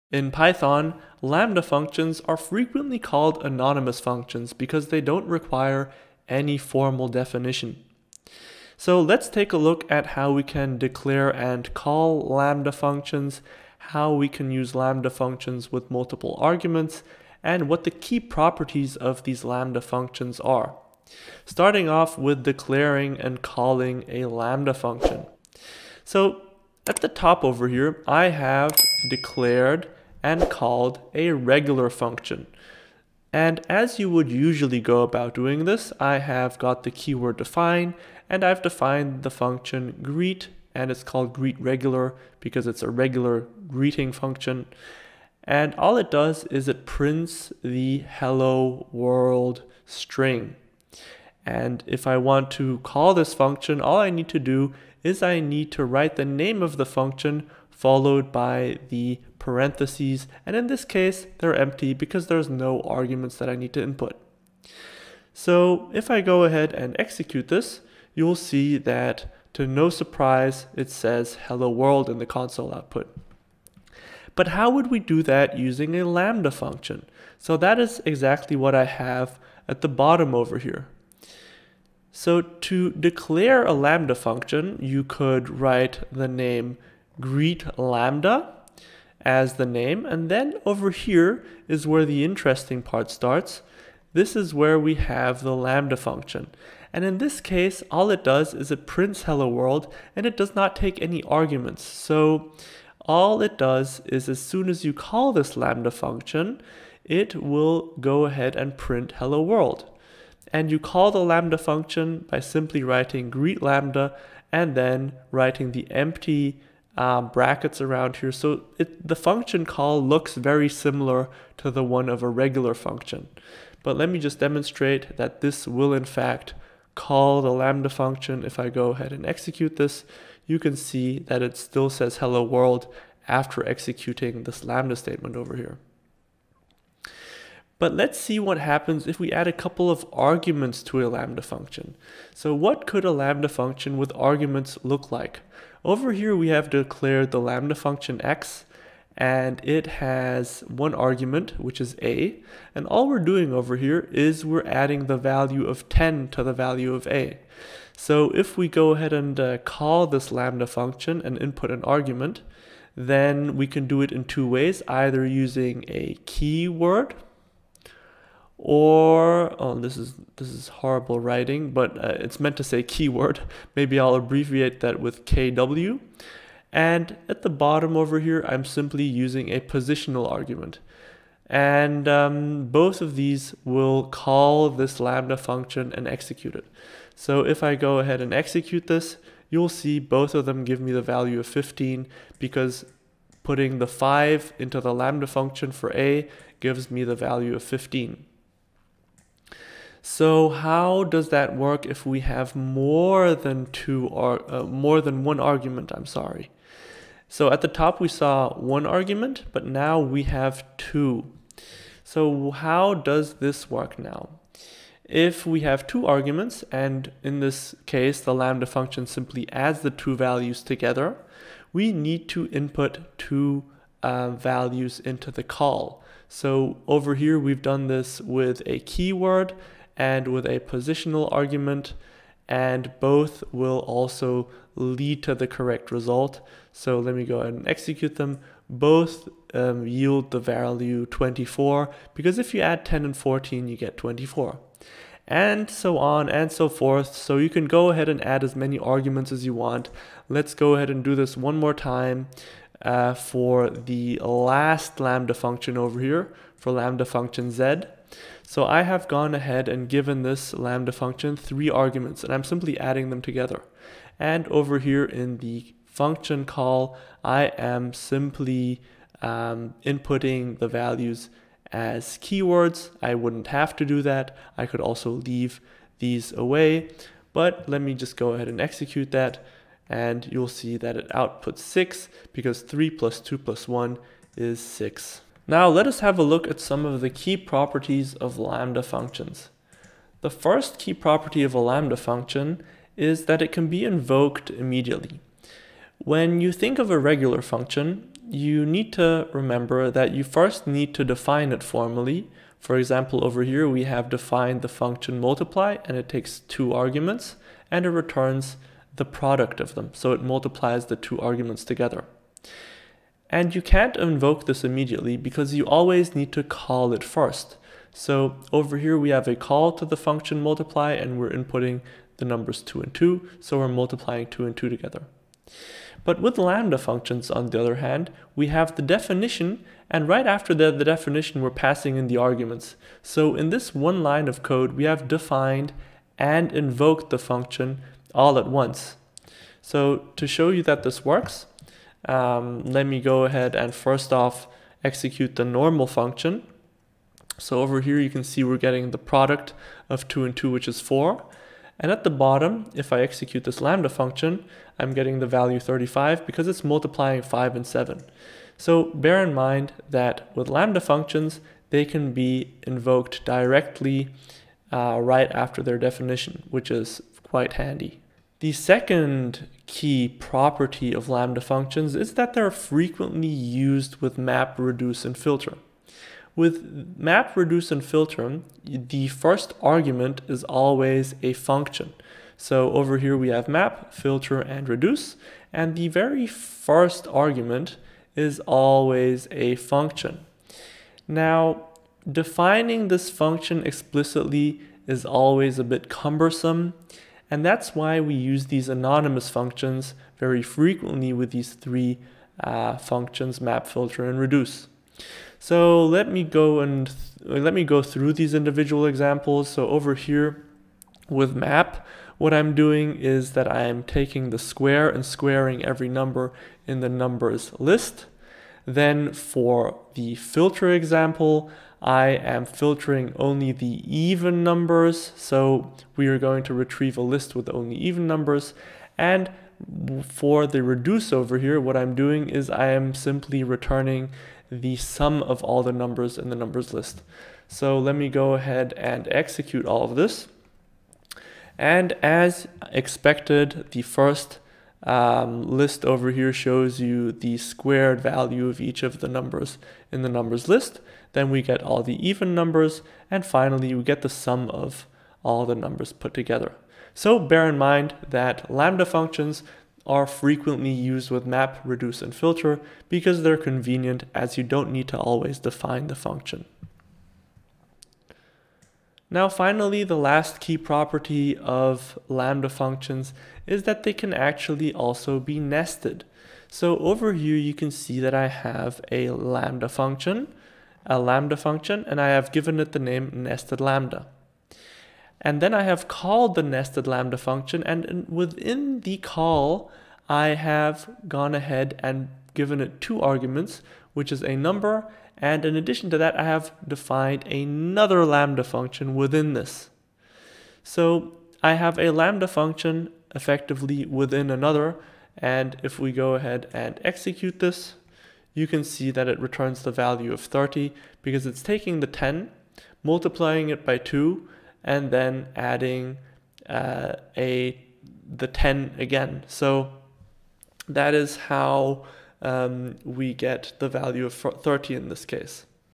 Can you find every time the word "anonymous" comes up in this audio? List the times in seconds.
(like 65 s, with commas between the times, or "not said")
3 s, 398 s.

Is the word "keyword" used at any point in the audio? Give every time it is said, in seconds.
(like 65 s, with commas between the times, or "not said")
36 s, 166 s, 172 s, 228 s, 272 s.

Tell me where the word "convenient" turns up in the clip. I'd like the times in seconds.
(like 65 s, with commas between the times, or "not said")
463 s.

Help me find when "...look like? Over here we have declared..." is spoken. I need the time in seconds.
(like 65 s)
144 s.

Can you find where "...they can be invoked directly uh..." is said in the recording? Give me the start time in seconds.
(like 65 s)
361 s.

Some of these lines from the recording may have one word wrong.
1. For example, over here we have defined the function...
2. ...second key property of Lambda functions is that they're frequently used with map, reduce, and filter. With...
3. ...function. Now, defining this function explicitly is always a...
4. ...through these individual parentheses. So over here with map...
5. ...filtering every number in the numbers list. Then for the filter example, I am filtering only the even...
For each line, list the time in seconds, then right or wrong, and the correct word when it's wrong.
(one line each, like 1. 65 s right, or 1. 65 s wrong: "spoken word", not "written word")
1. 302 s right
2. 368 s right
3. 389 s right
4. 407 s wrong: "examples", not "parentheses"
5. 415 s wrong: "squaring", not "filtering".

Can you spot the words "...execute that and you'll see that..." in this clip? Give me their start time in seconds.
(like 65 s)
278 s.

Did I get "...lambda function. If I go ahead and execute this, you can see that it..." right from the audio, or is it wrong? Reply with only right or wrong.
right.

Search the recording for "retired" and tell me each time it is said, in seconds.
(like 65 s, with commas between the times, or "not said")
not said.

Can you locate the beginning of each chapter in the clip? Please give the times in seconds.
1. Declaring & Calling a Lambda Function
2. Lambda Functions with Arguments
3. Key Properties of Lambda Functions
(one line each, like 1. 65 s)
1. 21 s
2. 138 s
3. 285 s.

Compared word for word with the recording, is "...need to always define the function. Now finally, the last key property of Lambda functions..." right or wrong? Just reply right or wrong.
right.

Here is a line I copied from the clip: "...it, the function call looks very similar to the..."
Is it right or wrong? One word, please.
right.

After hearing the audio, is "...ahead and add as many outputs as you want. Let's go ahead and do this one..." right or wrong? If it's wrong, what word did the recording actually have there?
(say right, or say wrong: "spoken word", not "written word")
wrong: "arguments", not "outputs".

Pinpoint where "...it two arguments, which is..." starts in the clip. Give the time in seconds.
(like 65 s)
492 s.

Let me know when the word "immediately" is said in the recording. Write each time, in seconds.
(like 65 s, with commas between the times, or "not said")
294 s, 314 s.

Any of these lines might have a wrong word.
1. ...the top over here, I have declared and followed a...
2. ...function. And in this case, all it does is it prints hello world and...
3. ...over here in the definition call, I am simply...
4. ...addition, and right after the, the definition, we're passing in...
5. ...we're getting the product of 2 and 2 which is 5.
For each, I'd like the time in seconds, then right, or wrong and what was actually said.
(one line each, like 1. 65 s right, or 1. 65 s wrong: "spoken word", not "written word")
1. 26 s wrong: "called", not "followed"
2. 95 s right
3. 264 s wrong: "function", not "definition"
4. 328 s wrong: "definition", not "addition"
5. 348 s wrong: "4", not "5".